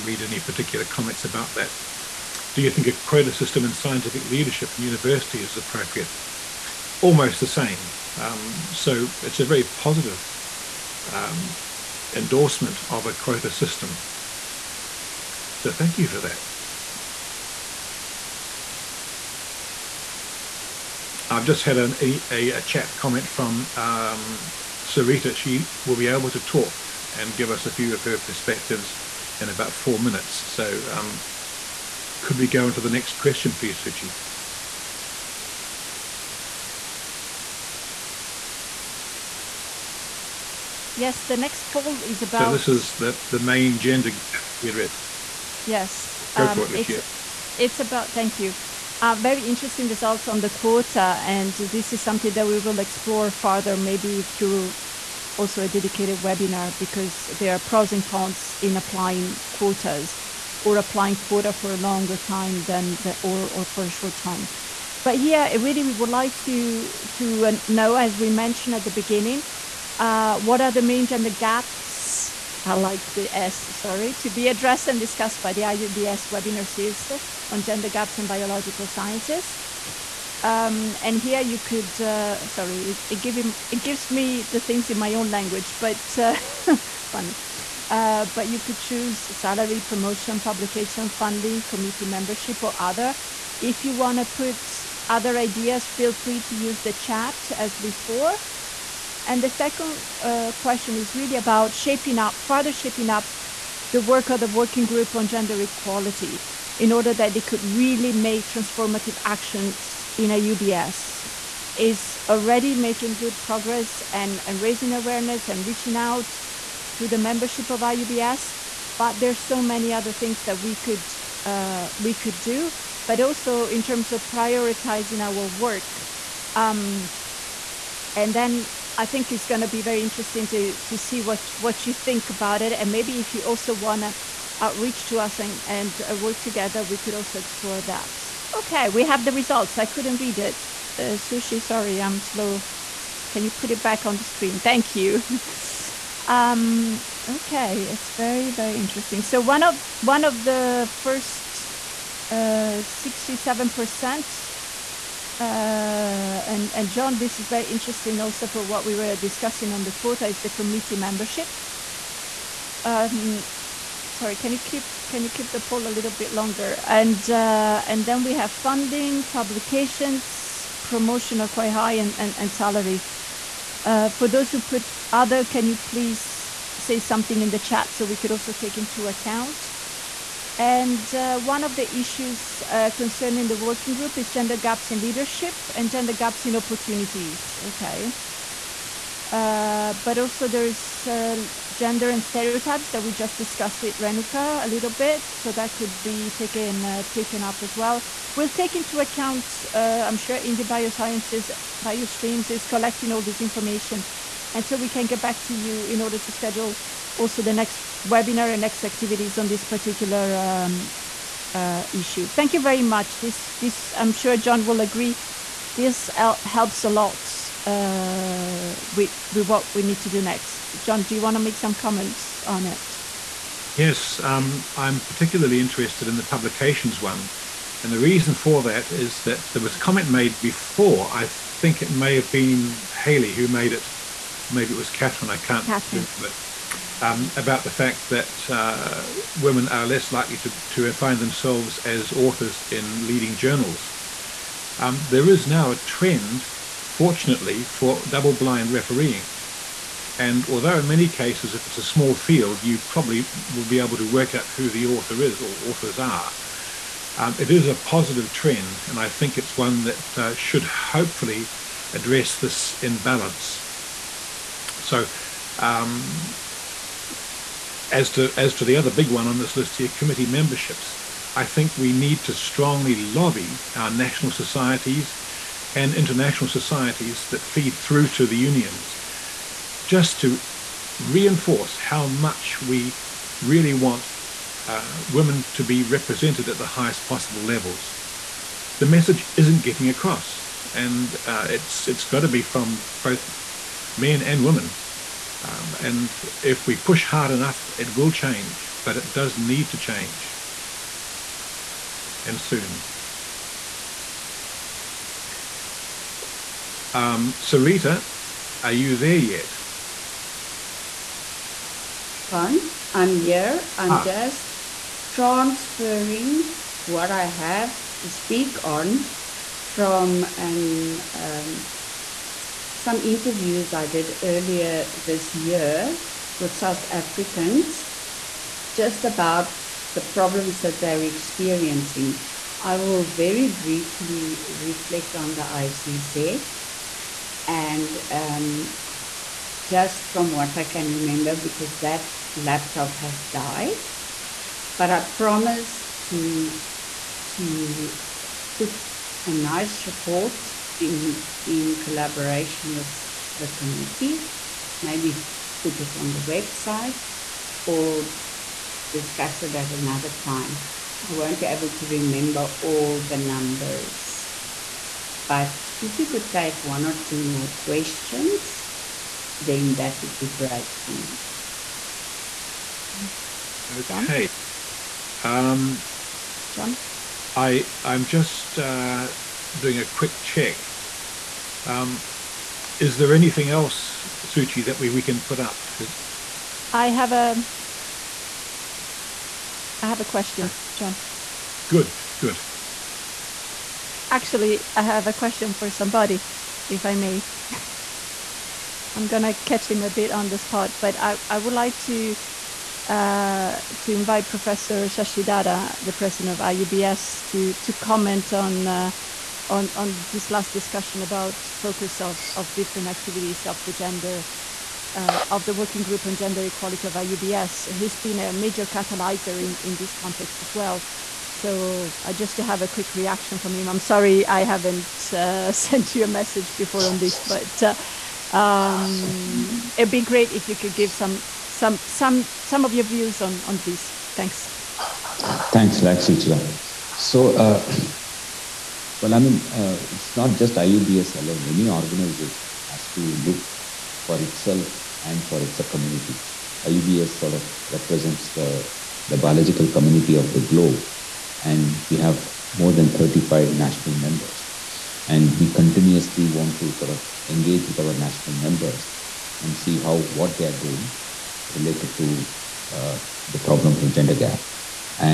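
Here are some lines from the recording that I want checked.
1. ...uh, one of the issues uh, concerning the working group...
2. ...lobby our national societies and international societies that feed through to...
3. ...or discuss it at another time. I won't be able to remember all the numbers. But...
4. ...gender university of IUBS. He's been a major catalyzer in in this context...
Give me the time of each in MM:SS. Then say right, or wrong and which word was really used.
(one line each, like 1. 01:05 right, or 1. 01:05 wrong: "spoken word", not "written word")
1. 03:01 right
2. 04:32 right
3. 05:57 right
4. 06:56 wrong: "equality", not "university".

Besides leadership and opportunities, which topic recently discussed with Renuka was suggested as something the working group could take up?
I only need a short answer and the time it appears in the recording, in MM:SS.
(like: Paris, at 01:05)
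Stereotypes, at 03:12.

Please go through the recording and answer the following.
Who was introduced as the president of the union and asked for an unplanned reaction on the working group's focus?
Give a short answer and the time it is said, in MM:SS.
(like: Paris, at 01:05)
Professor Shashidhara, at 06:44.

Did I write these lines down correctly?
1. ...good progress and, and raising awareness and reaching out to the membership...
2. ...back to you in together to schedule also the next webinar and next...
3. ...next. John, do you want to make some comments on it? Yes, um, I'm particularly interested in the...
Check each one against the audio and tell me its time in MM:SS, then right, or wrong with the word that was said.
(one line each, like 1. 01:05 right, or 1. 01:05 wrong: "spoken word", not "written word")
1. 01:53 right
2. 03:25 wrong: "order", not "together"
3. 03:40 right.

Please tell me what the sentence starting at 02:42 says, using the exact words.
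Um, sorry, can you keep can you keep the poll a little bit longer?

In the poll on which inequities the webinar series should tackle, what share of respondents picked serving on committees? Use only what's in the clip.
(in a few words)
67 percent.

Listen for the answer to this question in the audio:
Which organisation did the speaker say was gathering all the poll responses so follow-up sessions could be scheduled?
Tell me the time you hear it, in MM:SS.
03:20.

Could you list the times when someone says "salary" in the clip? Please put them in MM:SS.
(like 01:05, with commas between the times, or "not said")
01:29, 02:52.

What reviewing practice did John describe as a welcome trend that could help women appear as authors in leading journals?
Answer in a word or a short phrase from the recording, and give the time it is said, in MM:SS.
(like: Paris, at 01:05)
Double blind refereeing, at 04:08.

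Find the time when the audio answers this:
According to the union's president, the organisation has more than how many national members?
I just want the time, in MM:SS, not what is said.
07:32.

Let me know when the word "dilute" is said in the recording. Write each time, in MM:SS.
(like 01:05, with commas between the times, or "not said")
not said.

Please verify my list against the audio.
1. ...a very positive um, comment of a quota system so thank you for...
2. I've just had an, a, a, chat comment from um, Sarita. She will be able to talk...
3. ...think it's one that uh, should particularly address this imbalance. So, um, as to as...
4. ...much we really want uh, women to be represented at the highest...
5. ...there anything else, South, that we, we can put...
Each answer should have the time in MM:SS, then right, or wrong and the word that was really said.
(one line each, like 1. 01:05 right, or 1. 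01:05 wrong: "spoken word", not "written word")
1. 00:09 wrong: "endorsement", not "comment"
2. 00:21 right
3. 04:19 wrong: "hopefully", not "particularly"
4. 04:42 right
5. 06:22 wrong: "Suchi", not "South".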